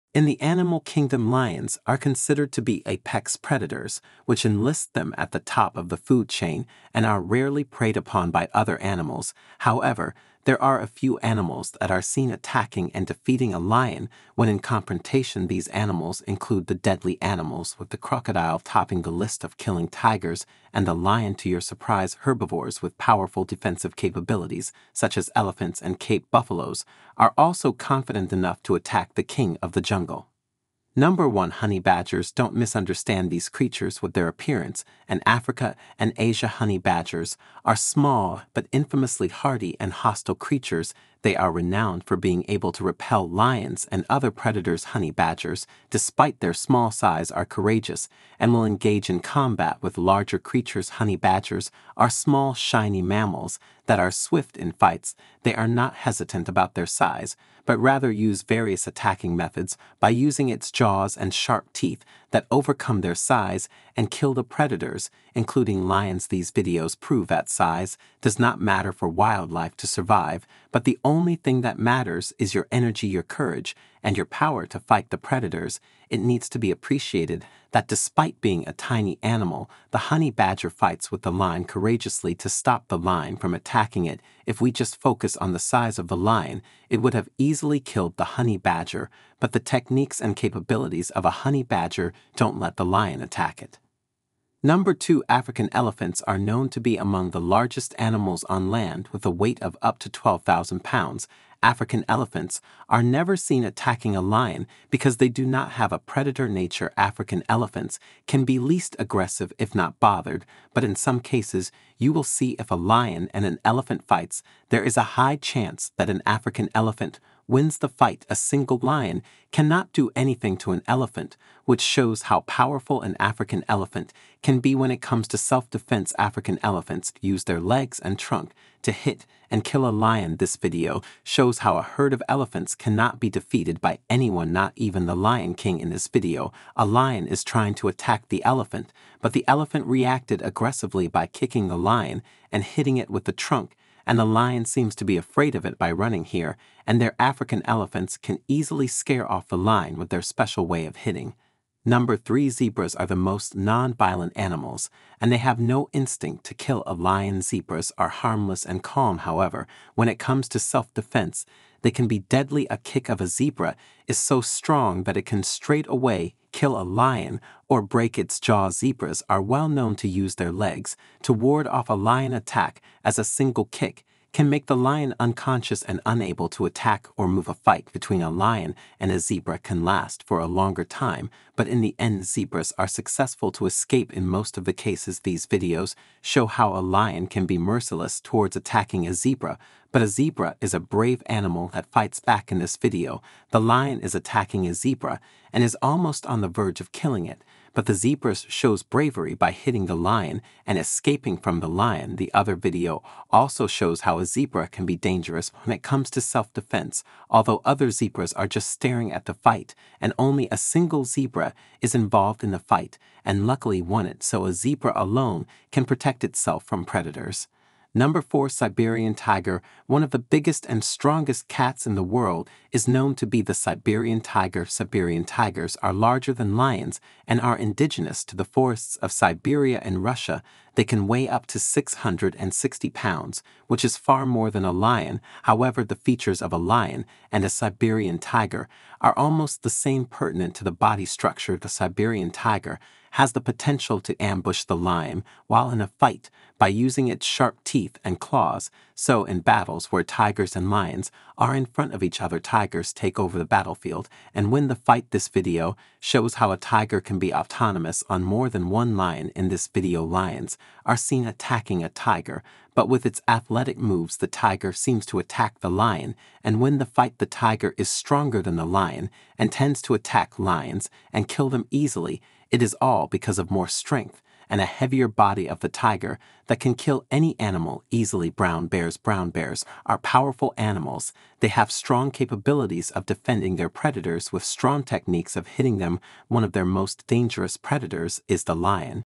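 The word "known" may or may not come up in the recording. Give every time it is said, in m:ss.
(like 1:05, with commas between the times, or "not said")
1:36, 2:49, 3:42.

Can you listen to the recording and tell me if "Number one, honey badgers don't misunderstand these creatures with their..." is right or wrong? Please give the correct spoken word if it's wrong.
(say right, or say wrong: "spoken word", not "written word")
right.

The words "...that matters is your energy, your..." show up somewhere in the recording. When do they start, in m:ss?
1:11.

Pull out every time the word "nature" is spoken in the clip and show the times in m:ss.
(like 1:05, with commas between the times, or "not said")
1:46.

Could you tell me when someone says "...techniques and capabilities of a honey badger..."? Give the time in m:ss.
1:29.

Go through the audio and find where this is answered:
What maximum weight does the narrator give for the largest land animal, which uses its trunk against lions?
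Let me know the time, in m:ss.
1:40.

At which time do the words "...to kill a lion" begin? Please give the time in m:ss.
2:36.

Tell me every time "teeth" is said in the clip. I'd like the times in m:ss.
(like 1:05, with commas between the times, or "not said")
1:01, 4:07.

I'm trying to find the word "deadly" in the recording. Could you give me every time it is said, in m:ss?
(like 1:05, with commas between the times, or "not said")
0:16, 2:42.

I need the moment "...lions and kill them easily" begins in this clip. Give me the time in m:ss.
4:30.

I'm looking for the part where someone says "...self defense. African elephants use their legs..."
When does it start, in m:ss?
2:05.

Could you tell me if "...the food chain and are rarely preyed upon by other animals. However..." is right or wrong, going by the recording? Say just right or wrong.
right.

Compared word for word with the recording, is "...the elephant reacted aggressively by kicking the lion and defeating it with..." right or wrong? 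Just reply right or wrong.
wrong.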